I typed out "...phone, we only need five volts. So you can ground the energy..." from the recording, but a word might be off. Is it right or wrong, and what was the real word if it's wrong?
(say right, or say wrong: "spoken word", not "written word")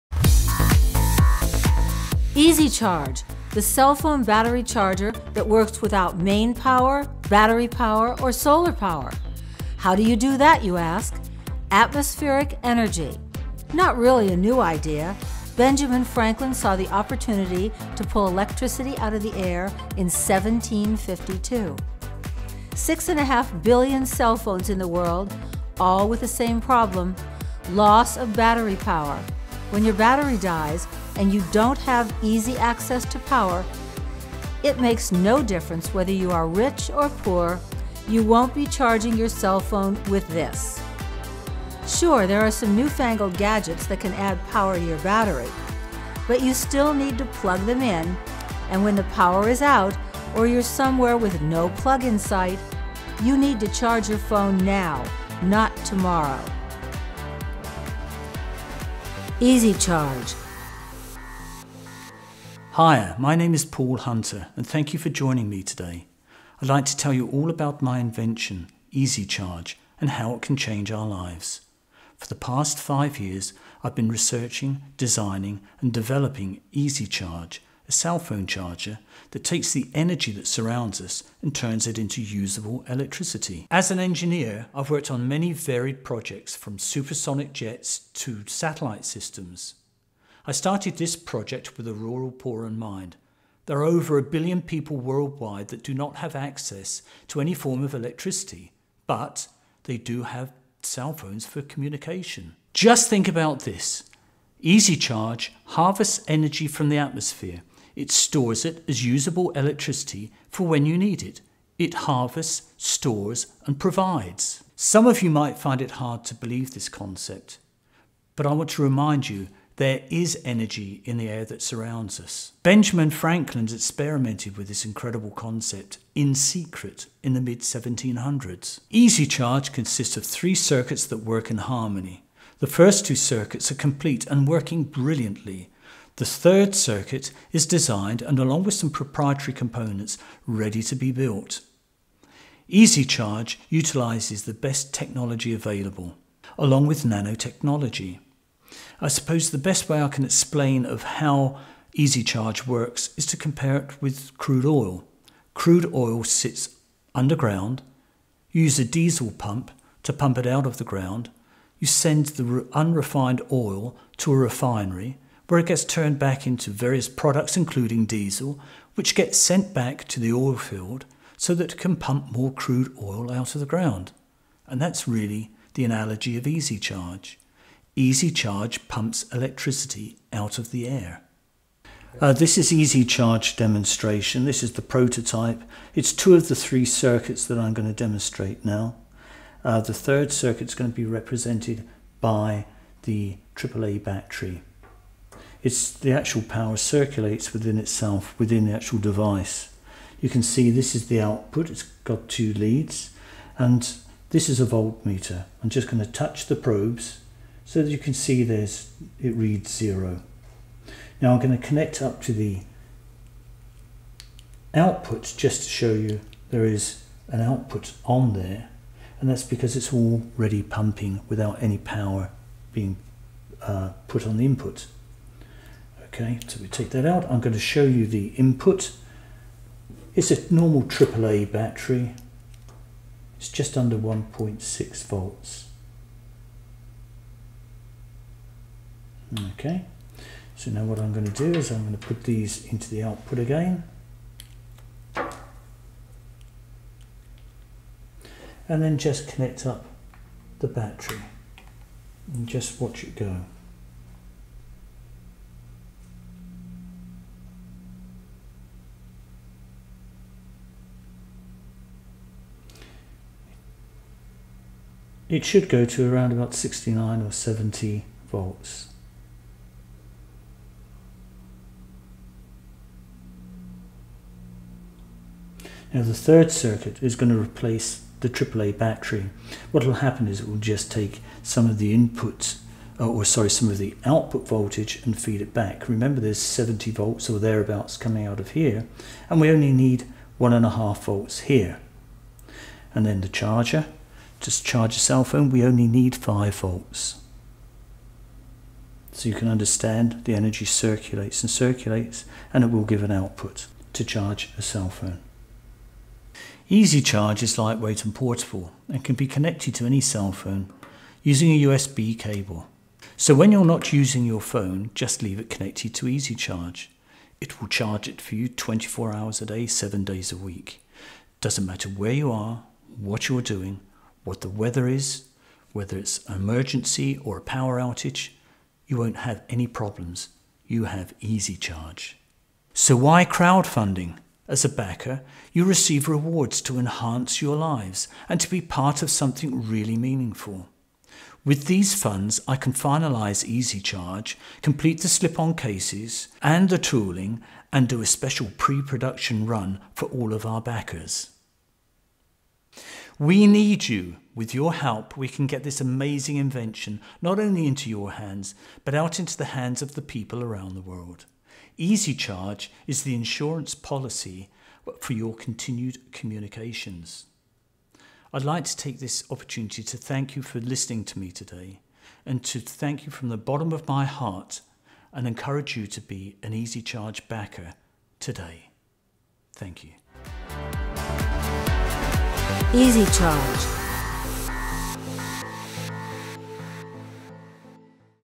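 wrong: "understand", not "ground".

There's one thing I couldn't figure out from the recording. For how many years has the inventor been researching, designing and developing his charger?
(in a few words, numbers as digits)
5 years.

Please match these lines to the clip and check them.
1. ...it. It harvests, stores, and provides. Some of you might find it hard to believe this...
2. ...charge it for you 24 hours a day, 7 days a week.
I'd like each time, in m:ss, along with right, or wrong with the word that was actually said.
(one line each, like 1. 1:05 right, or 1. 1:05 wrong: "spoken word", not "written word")
1. 1:51 right
2. 5:17 right.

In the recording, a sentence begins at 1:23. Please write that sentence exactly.
As an engineer, I've worked on many varied projects from supersonic jets to satellite systems.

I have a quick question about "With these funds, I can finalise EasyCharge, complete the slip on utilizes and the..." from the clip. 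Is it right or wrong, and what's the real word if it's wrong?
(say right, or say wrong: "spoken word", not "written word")
wrong: "cases", not "utilizes".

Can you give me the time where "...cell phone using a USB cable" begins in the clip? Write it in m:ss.
5:09.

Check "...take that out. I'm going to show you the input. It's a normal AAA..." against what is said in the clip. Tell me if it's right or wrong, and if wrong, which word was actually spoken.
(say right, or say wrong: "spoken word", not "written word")
right.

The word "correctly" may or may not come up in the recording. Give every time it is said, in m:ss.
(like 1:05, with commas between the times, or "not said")
not said.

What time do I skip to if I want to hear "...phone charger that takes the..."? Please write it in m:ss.
1:18.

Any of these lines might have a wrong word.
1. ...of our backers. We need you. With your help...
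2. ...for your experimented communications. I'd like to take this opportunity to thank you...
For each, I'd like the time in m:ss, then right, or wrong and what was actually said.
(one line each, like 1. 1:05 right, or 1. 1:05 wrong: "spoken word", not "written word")
1. 5:50 right
2. 6:04 wrong: "continued", not "experimented".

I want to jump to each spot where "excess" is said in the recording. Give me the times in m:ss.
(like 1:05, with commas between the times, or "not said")
not said.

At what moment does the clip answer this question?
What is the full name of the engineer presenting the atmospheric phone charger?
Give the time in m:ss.
1:03.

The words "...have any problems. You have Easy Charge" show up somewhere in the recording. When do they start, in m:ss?
5:29.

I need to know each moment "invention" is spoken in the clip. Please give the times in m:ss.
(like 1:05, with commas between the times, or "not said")
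1:07, 5:56.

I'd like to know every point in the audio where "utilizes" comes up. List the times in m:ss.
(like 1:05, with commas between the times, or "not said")
2:23.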